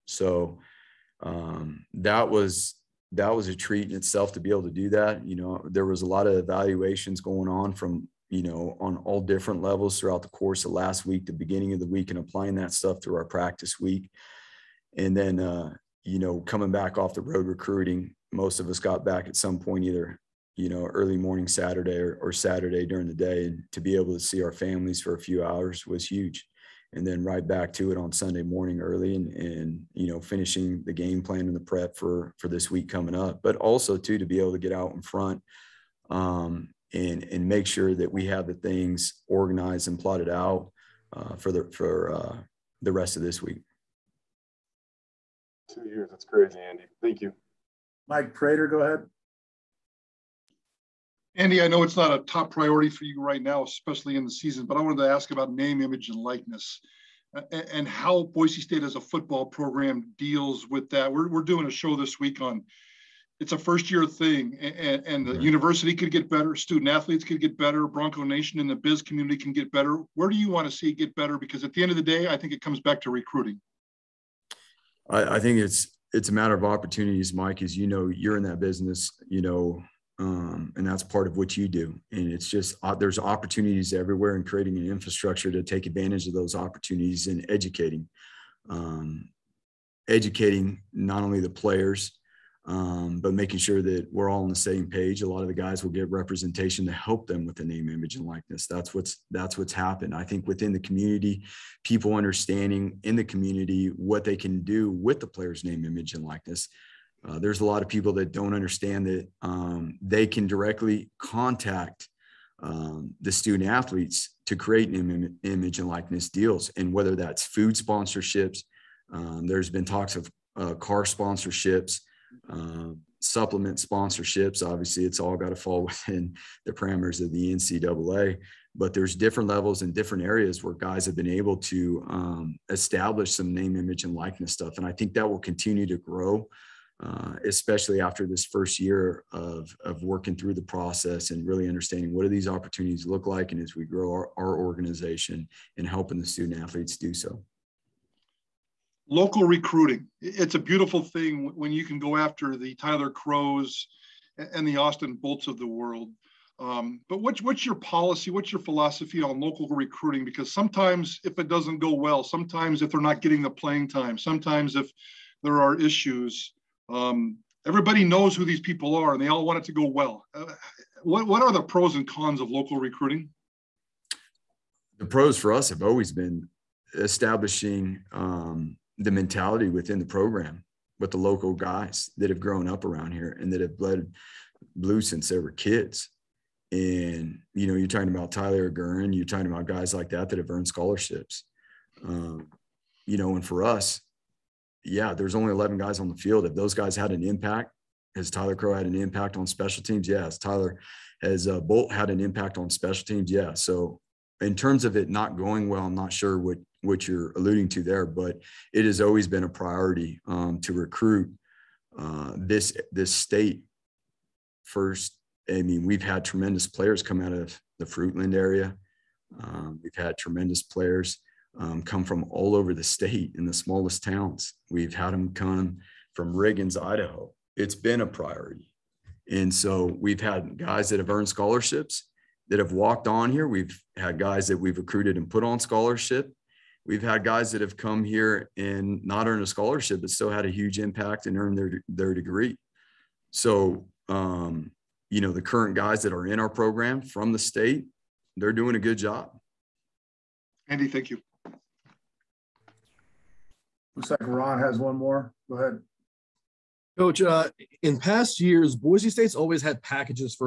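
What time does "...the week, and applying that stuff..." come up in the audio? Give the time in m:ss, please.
0:11.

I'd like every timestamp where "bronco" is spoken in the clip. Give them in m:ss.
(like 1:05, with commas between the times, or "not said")
1:07.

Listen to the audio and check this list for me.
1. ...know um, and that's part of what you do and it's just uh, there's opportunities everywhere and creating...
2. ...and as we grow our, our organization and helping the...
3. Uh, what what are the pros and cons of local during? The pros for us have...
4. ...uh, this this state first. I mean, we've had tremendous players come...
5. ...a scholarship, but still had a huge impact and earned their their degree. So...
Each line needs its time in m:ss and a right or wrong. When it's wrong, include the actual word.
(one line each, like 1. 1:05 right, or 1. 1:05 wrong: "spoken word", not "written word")
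1. 1:19 right
2. 2:23 right
3. 2:50 wrong: "recruiting", not "during"
4. 3:31 right
5. 3:59 right.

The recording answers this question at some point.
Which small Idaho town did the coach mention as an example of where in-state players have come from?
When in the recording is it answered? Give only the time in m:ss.
3:46.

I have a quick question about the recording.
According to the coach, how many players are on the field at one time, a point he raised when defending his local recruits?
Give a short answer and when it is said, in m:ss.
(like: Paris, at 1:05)
11, at 3:15.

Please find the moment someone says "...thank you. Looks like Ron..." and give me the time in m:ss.
4:10.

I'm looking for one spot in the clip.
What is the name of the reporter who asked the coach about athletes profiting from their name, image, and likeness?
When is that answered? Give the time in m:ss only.
0:48.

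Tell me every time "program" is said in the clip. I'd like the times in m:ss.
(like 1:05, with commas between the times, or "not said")
0:59, 3:00, 4:06.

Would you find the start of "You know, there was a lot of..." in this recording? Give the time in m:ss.
0:05.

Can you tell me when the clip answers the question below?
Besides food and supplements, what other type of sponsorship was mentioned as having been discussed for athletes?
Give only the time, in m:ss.
2:00.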